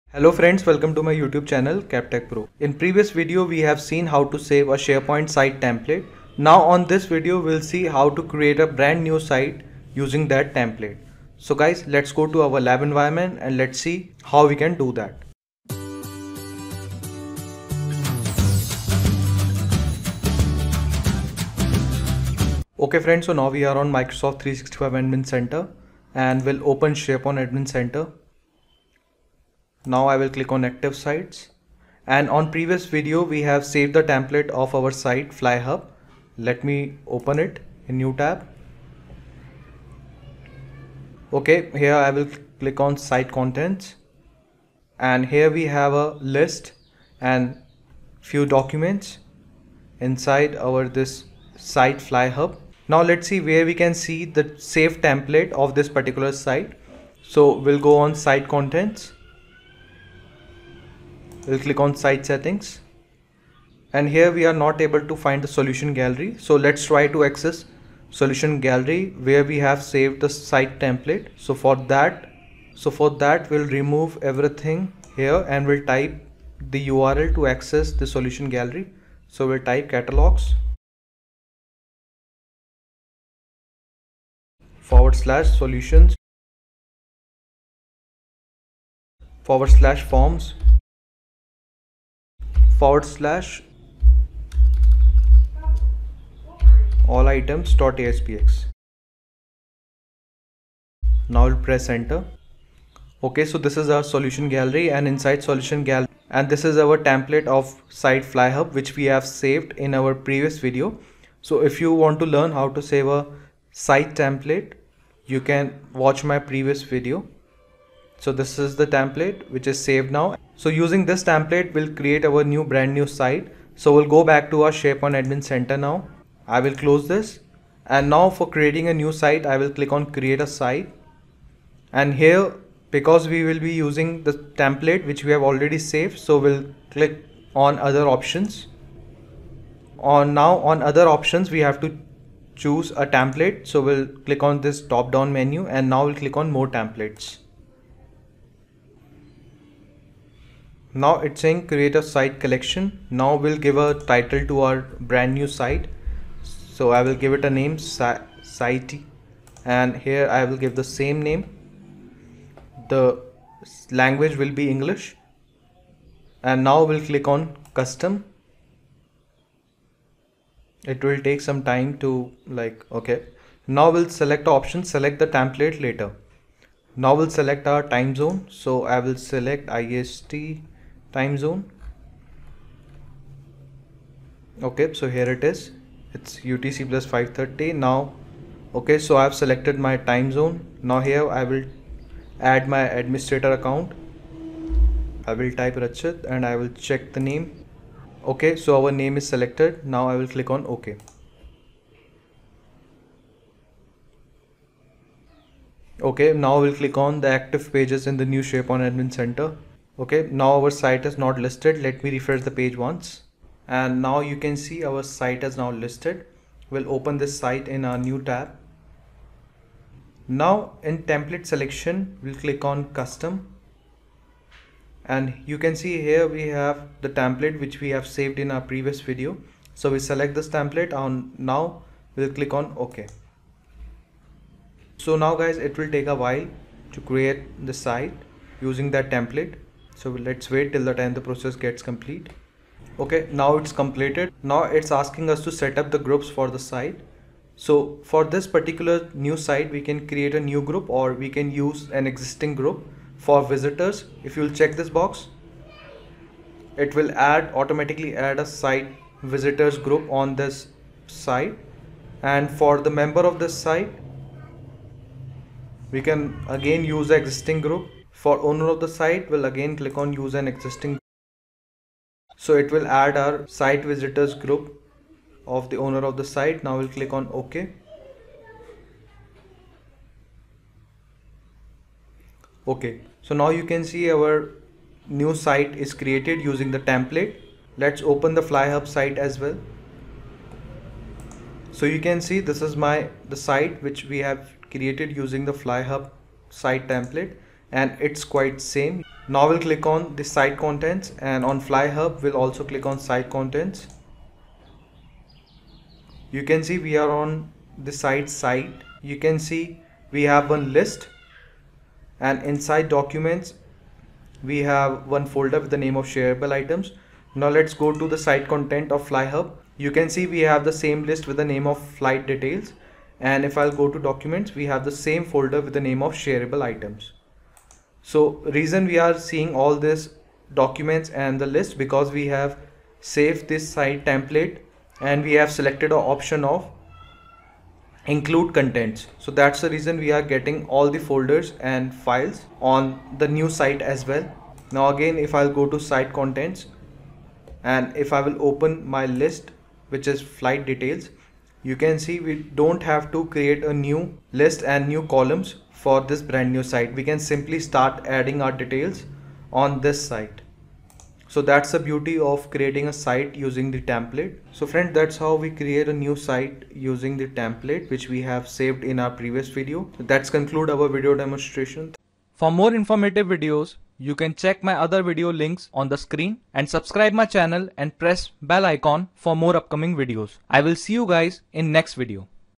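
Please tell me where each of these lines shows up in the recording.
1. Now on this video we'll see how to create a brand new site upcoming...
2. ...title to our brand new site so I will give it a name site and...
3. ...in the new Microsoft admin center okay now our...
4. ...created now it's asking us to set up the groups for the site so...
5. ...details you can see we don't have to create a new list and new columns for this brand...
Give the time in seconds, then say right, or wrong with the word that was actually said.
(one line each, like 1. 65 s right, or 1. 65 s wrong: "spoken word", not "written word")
1. 6 s wrong: "using", not "upcoming"
2. 154 s right
3. 208 s wrong: "SharePoint", not "Microsoft"
4. 243 s wrong: "completed", not "created"
5. 350 s right.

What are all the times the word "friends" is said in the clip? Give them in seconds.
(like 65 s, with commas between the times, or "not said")
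0 s, 22 s, 364 s.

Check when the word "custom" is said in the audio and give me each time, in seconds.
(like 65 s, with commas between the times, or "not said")
167 s, 223 s.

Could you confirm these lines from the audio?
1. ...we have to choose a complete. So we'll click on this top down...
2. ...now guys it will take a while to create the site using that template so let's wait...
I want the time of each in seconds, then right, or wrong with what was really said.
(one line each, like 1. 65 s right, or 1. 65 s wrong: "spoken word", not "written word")
1. 141 s wrong: "template", not "complete"
2. 235 s right.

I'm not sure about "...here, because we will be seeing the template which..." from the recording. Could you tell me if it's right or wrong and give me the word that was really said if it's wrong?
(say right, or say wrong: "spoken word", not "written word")
wrong: "using", not "seeing".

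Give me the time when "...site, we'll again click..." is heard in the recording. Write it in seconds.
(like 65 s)
268 s.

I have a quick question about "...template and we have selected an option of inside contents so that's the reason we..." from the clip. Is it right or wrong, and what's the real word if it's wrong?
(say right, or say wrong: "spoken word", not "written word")
wrong: "include", not "inside".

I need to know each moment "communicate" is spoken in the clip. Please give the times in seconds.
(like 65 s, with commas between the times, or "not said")
not said.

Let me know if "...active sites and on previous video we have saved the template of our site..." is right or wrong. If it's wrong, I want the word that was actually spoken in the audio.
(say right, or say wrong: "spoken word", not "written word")
right.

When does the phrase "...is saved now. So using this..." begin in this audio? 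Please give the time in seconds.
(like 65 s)
119 s.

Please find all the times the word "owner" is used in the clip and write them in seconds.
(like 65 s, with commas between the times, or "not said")
268 s, 275 s.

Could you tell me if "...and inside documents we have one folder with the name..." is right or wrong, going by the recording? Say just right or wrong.
right.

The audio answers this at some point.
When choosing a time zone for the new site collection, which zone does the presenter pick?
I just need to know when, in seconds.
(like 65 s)
179 s.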